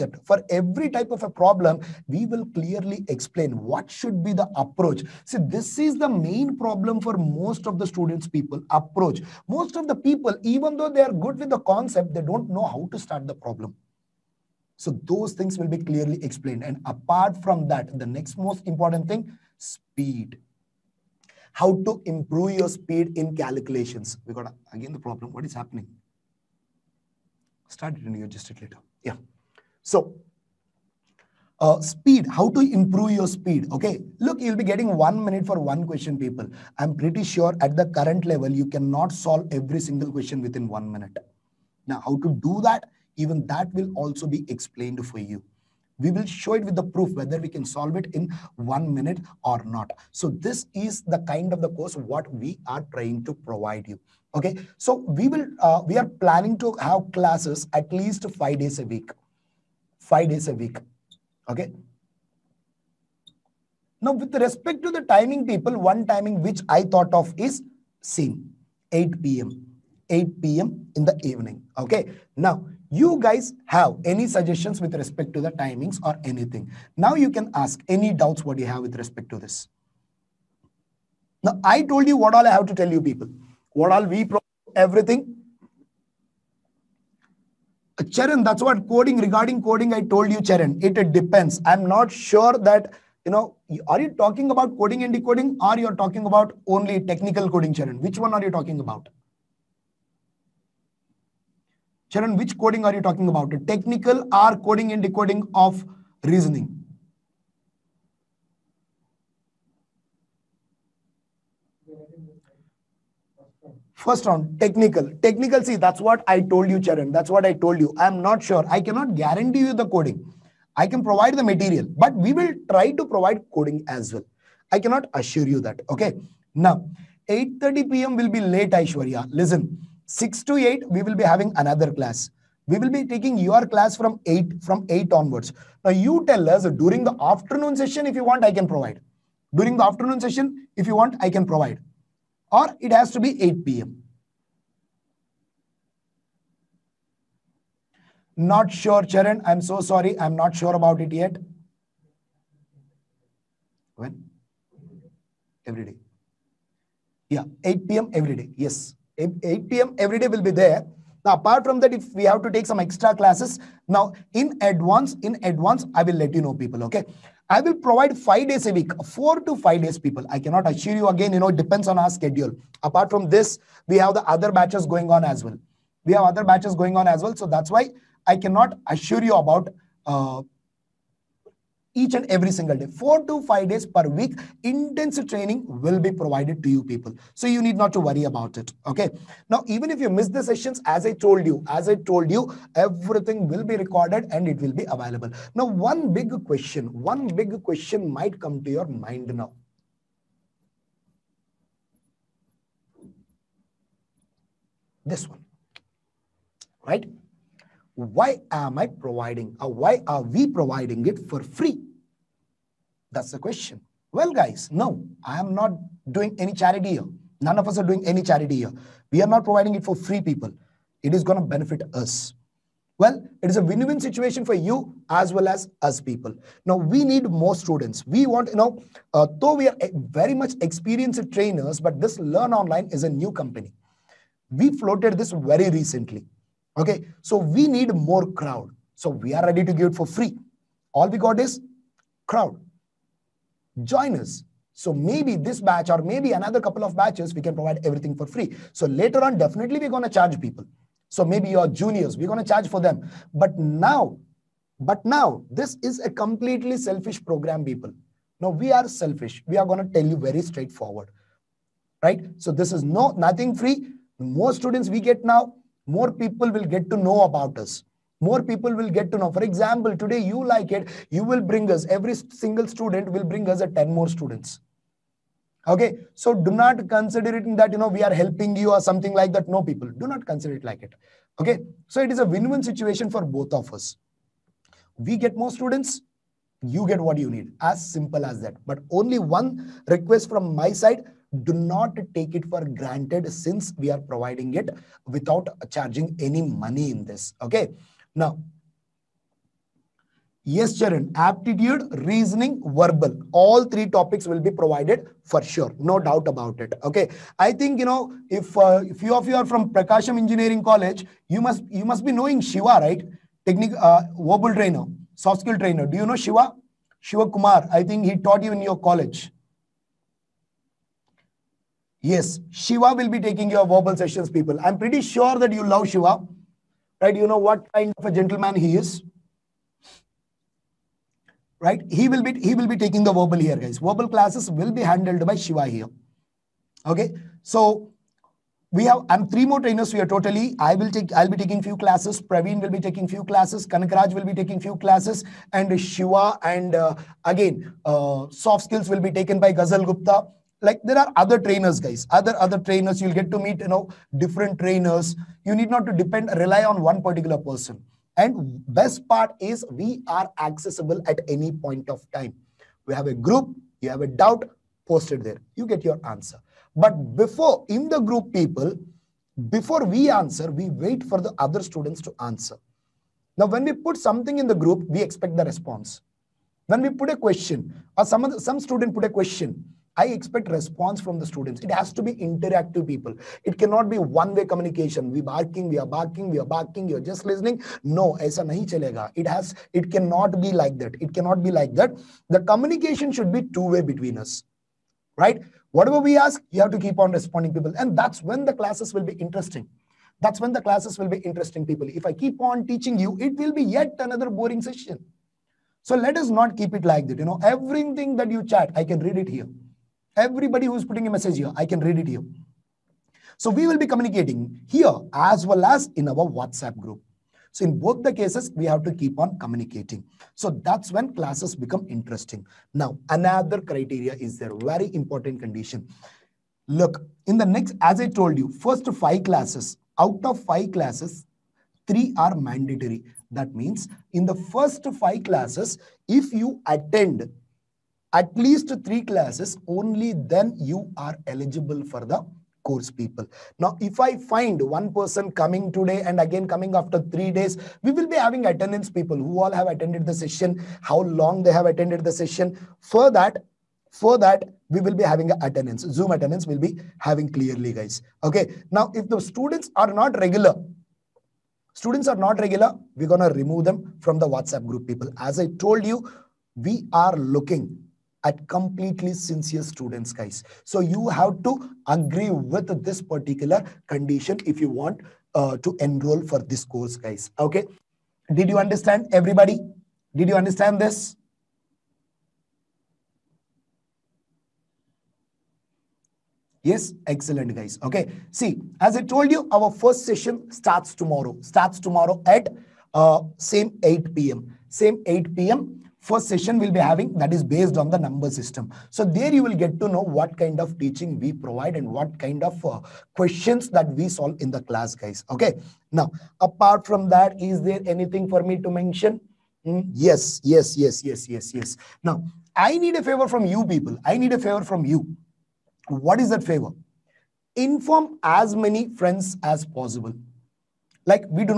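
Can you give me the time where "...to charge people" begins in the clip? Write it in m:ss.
4:10.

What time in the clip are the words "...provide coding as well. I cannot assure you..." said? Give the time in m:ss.
2:03.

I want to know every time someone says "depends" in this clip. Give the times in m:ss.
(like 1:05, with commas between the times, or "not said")
1:31, 2:51, 5:55.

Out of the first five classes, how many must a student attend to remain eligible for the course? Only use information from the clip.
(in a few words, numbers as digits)
3.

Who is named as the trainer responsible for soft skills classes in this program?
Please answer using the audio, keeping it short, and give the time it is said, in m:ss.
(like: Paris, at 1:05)
Ghazal Gupta, at 5:49.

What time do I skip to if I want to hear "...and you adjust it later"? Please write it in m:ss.
0:28.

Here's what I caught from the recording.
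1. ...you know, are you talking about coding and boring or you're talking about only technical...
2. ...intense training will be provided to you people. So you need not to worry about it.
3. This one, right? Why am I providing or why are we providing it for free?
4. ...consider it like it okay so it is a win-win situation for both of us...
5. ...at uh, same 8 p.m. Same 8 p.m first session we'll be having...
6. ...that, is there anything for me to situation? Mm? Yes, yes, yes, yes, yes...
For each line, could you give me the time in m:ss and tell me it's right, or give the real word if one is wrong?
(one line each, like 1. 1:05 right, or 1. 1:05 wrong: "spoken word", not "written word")
1. 1:33 wrong: "decoding", not "boring"
2. 3:04 right
3. 3:25 right
4. 4:40 right
5. 8:12 right
6. 8:27 wrong: "mention", not "situation".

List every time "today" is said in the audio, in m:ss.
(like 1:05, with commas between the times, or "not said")
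4:29, 7:25.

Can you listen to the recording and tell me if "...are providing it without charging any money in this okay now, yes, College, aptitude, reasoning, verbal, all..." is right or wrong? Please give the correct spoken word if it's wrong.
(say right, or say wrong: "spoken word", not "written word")
wrong: "Charan", not "College".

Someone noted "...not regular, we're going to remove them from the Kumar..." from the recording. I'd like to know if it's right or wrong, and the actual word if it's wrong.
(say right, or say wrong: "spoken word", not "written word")
wrong: "WhatsApp", not "Kumar".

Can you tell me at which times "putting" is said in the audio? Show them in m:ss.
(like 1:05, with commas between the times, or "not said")
6:50.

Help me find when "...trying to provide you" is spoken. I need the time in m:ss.
0:52.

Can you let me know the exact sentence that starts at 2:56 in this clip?
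We have other batches going on as well.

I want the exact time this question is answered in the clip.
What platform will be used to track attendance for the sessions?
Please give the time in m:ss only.
7:35.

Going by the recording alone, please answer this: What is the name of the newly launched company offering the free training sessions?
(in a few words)
Learn Online.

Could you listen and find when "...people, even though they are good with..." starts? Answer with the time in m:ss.
0:09.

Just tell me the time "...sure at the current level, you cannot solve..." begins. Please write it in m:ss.
0:37.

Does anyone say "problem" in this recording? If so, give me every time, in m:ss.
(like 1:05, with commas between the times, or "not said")
0:01, 0:06, 0:13, 0:24.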